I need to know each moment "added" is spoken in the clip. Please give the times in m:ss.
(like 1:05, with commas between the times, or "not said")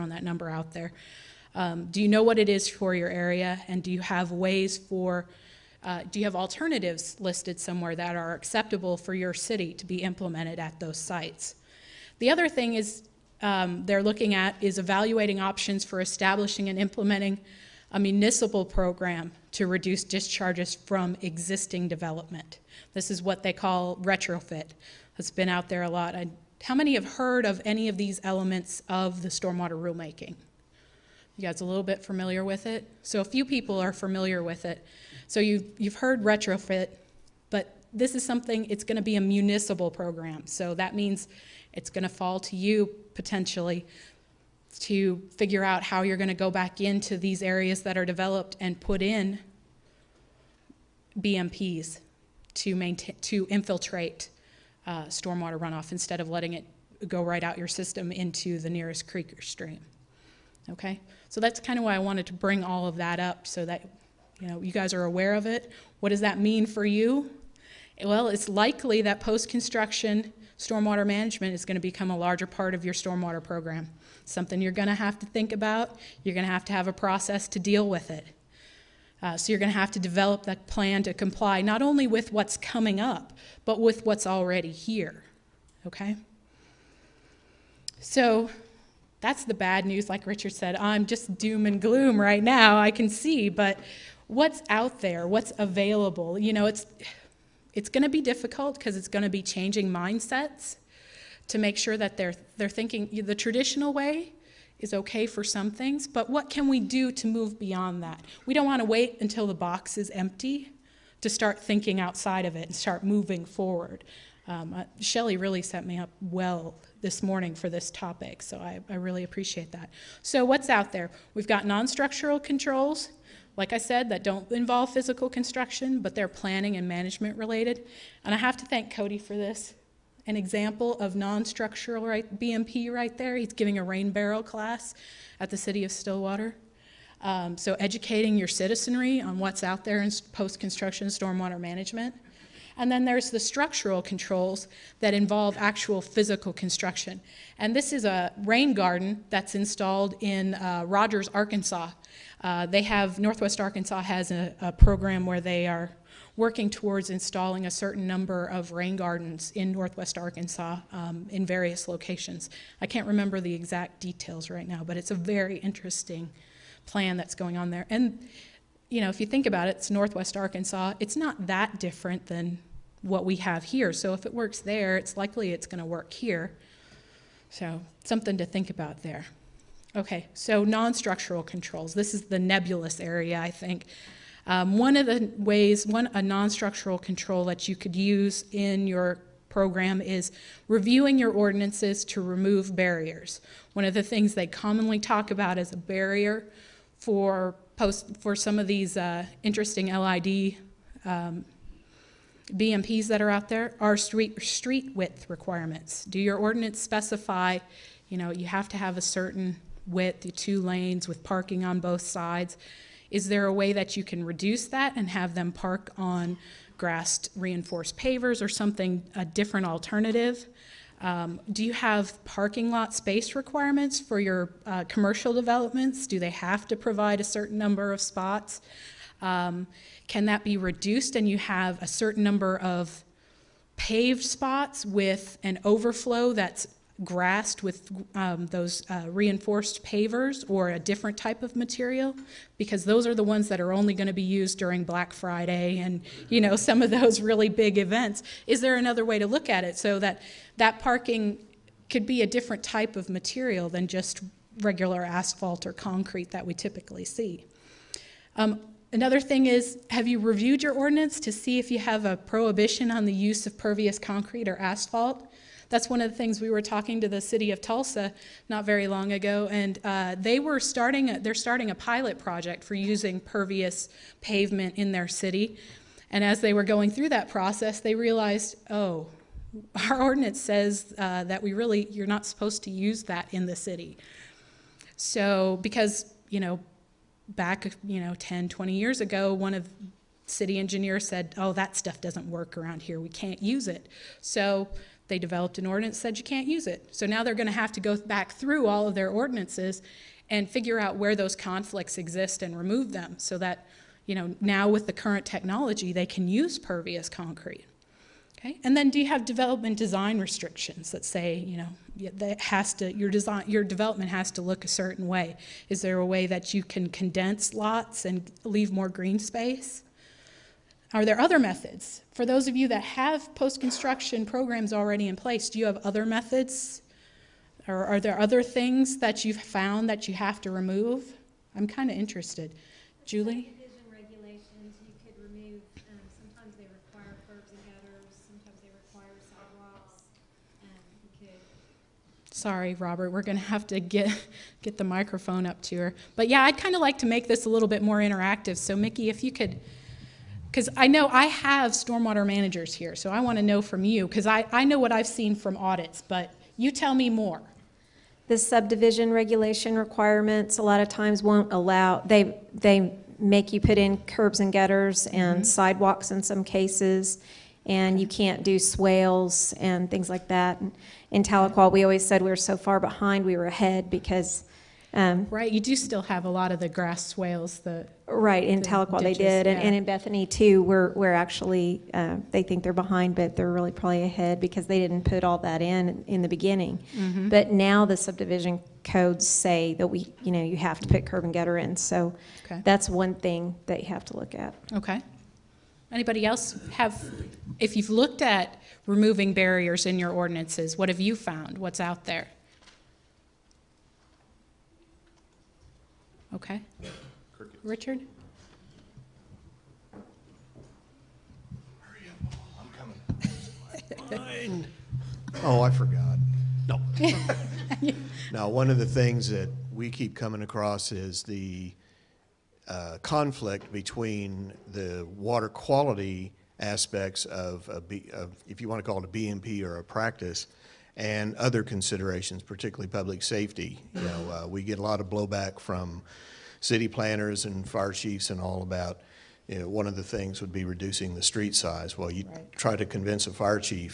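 not said.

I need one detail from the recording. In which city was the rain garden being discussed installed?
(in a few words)
Rogers, Arkansas.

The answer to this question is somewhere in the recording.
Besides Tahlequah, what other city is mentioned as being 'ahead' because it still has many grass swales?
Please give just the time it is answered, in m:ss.
6:19.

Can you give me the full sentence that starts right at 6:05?
sidewalks in some cases, and you can't do swales and things like that.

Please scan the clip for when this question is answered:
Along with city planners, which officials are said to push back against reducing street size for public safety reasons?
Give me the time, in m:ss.
7:17.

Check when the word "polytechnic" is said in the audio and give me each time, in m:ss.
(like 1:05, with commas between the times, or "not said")
not said.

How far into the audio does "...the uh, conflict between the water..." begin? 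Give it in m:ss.
7:01.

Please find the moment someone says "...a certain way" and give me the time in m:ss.
5:14.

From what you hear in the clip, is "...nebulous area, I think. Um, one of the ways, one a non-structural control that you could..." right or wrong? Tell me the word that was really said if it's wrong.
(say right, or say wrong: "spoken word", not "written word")
right.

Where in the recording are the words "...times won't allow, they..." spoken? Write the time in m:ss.
6:00.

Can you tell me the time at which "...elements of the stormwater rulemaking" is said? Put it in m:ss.
0:28.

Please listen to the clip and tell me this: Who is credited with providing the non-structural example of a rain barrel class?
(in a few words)
Cody.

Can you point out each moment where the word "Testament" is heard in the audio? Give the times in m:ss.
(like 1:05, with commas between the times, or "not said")
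not said.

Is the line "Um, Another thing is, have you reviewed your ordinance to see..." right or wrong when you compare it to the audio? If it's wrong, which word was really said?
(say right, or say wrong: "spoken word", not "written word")
right.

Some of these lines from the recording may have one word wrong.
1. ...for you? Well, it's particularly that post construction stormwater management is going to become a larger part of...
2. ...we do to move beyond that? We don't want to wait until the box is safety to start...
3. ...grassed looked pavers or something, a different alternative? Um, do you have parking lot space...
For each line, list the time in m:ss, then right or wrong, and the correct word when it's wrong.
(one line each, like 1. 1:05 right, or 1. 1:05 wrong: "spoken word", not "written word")
1. 1:06 wrong: "likely", not "particularly"
2. 1:46 wrong: "empty", not "safety"
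3. 3:36 wrong: "reinforced", not "looked".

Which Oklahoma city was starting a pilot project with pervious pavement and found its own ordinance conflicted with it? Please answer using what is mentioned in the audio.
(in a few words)
Tulsa.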